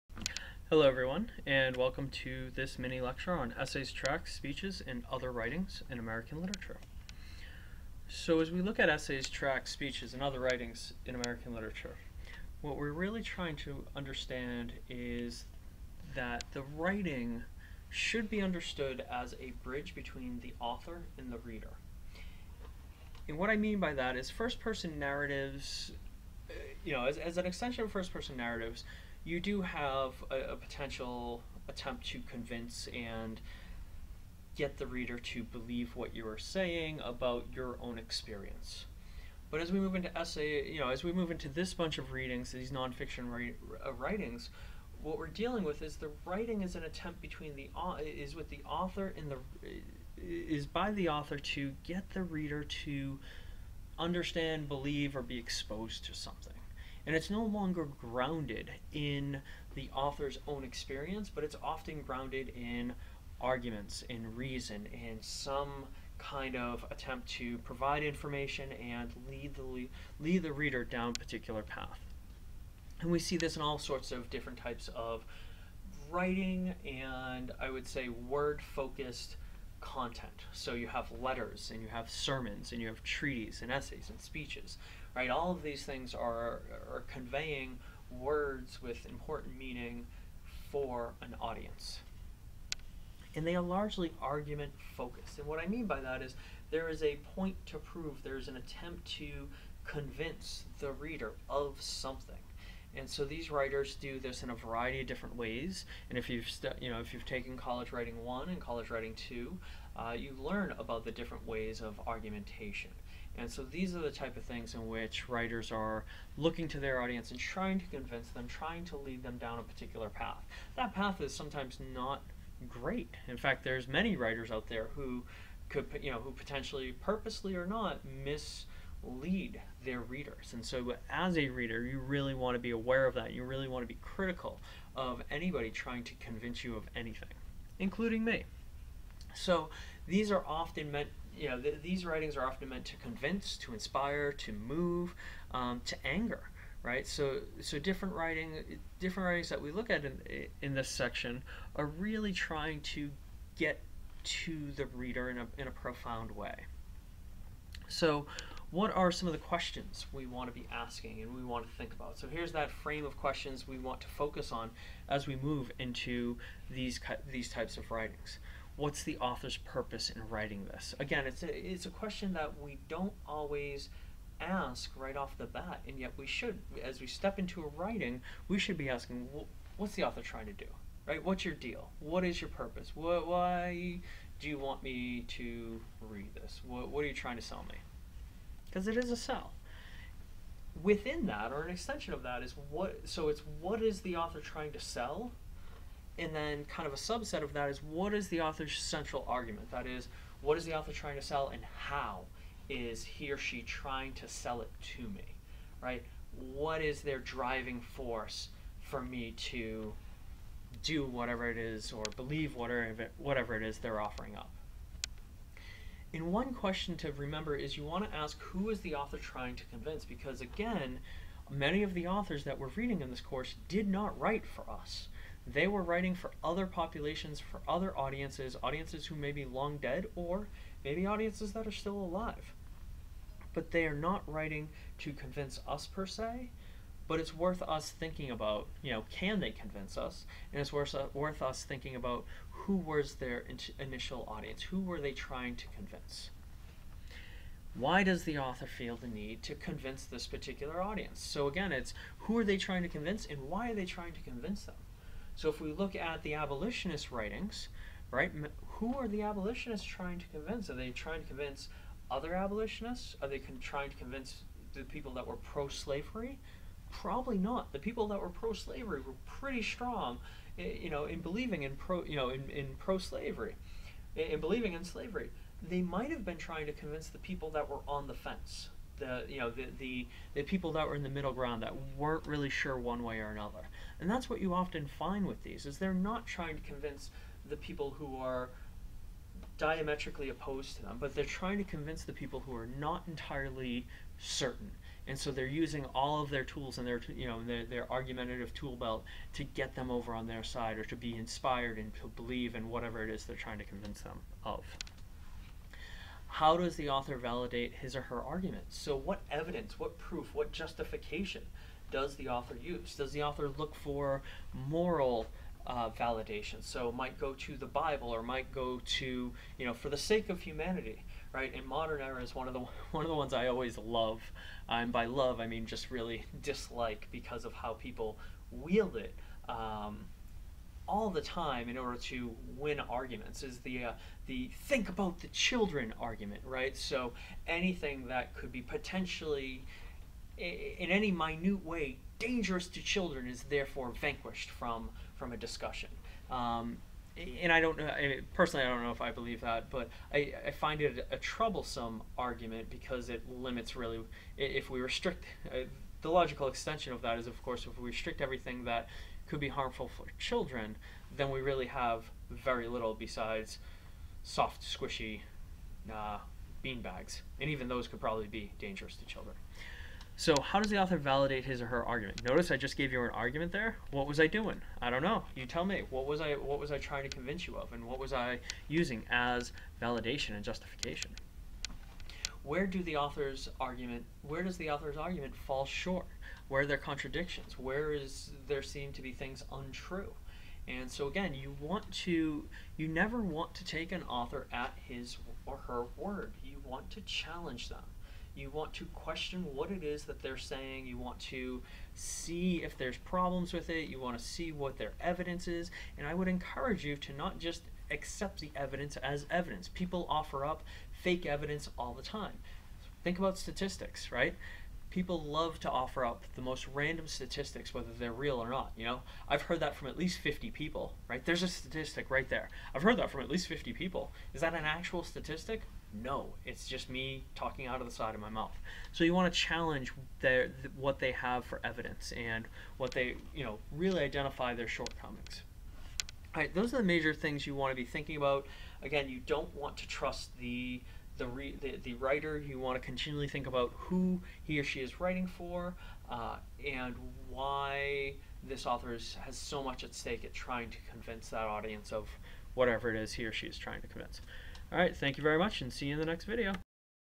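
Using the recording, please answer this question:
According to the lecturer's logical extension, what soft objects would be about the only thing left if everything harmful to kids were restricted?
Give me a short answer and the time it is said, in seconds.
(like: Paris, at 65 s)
Bean bags, at 366 s.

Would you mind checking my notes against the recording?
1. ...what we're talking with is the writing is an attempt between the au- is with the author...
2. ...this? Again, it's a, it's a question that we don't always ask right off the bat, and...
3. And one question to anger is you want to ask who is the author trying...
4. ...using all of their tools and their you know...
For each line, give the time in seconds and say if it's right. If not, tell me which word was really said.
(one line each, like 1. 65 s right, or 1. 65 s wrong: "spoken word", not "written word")
1. 45 s wrong: "dealing", not "talking"
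2. 170 s right
3. 216 s wrong: "remember", not "anger"
4. 295 s right.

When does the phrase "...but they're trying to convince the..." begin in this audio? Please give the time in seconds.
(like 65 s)
290 s.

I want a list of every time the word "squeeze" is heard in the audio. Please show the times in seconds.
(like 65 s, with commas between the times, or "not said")
not said.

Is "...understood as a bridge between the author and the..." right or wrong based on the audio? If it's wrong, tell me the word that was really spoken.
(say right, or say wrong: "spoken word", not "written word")
right.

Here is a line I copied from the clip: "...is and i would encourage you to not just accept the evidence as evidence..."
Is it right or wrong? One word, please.
right.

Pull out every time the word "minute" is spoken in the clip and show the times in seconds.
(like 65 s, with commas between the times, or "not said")
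341 s.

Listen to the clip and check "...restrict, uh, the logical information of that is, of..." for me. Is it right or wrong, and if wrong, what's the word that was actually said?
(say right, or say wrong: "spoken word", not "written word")
wrong: "extension", not "information".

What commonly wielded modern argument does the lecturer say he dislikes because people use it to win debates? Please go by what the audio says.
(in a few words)
Think about the children.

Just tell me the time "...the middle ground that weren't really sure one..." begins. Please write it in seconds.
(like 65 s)
281 s.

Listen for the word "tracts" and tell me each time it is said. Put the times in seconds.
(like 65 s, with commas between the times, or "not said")
3 s, 9 s.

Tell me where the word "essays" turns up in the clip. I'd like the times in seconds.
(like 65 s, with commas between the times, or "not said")
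3 s, 8 s, 40 s, 83 s.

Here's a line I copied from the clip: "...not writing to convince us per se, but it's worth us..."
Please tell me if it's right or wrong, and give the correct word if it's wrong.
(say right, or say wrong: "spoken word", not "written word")
right.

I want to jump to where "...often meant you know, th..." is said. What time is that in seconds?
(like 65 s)
140 s.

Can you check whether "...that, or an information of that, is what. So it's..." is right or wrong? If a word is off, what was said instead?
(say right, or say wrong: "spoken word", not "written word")
wrong: "extension", not "information".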